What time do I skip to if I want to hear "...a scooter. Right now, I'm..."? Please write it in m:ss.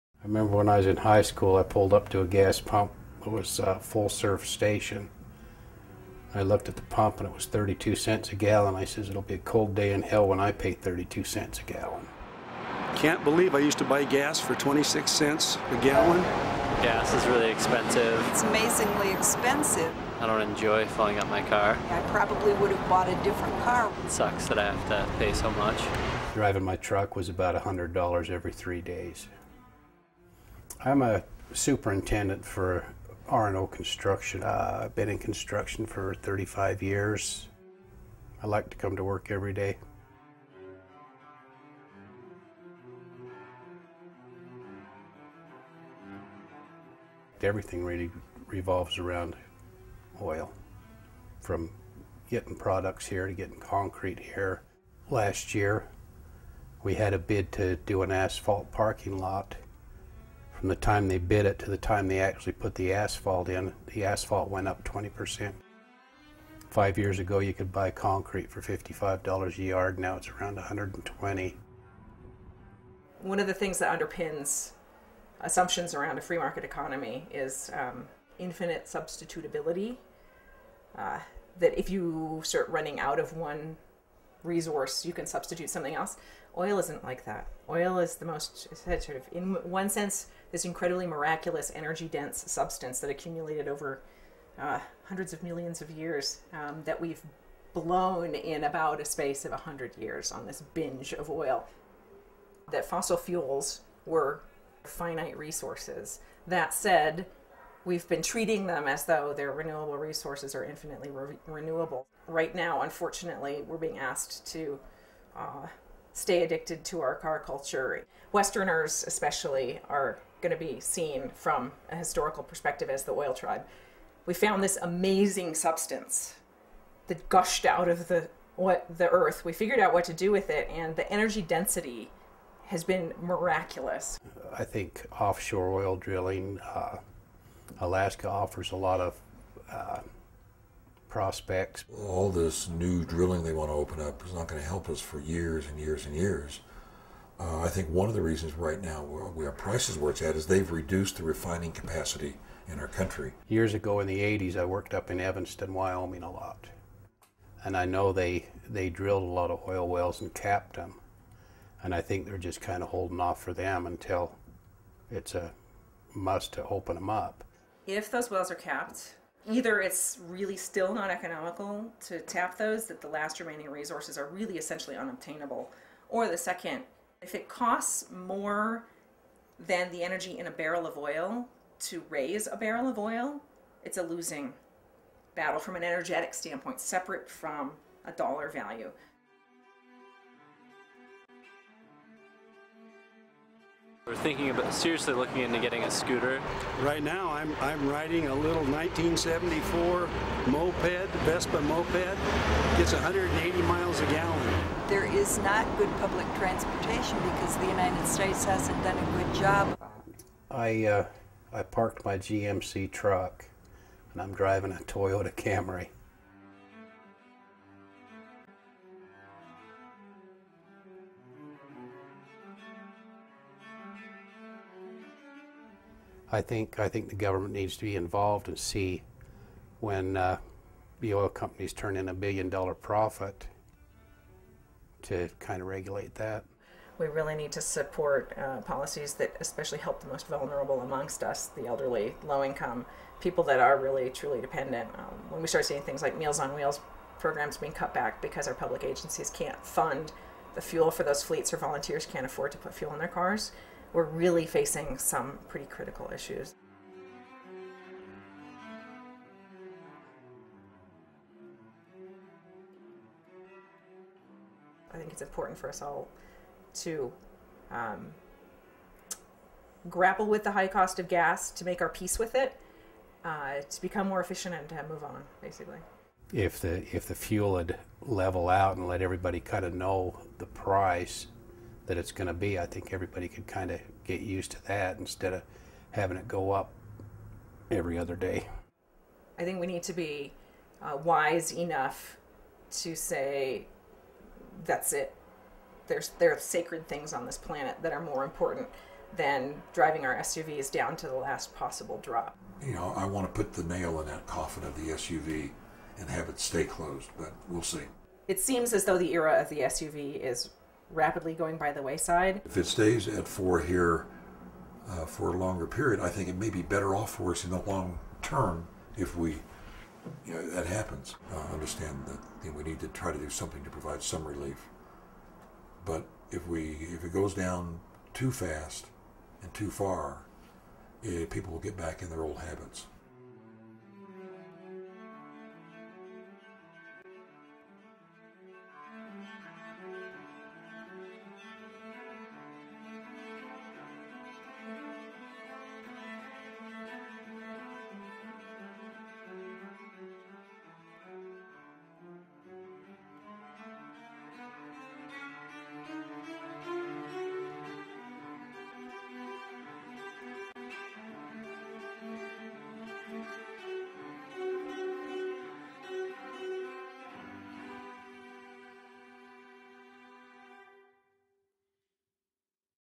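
3:15.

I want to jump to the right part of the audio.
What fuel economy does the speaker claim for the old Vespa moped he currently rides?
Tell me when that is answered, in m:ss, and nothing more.
3:22.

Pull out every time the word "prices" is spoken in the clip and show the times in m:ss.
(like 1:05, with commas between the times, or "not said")
2:29, 4:40.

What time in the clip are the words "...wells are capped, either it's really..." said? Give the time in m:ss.
2:48.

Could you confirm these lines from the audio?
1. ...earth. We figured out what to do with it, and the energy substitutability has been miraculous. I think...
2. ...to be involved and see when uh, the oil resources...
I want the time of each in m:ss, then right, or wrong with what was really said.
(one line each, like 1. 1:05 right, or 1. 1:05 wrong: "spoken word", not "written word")
1. 2:09 wrong: "density", not "substitutability"
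2. 3:47 wrong: "companies", not "resources".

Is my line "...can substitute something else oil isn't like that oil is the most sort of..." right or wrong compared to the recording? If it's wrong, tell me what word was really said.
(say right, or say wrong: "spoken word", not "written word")
right.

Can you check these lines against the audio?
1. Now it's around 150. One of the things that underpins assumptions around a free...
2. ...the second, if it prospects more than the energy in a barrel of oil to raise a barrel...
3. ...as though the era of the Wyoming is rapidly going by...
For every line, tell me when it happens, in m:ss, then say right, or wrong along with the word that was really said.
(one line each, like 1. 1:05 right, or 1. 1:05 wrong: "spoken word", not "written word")
1. 1:09 wrong: "120", not "150"
2. 2:56 wrong: "costs", not "prospects"
3. 5:08 wrong: "SUV", not "Wyoming".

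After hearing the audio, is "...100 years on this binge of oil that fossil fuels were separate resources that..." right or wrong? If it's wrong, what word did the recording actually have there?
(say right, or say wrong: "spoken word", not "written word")
wrong: "finite", not "separate".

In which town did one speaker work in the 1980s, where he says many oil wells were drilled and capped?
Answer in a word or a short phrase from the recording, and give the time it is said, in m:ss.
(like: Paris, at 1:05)
Evanston, Wyoming, at 2:35.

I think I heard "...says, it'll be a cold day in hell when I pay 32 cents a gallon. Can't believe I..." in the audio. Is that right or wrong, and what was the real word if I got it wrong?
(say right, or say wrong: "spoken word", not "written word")
right.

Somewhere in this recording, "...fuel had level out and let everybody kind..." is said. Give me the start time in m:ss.
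4:37.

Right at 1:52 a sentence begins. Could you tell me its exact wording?
Right now, unfortunately, we're being asked to uh, stay addicted to our car culture.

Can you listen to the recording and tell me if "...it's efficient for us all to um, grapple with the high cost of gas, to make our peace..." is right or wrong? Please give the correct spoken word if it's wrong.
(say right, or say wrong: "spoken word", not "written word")
wrong: "important", not "efficient".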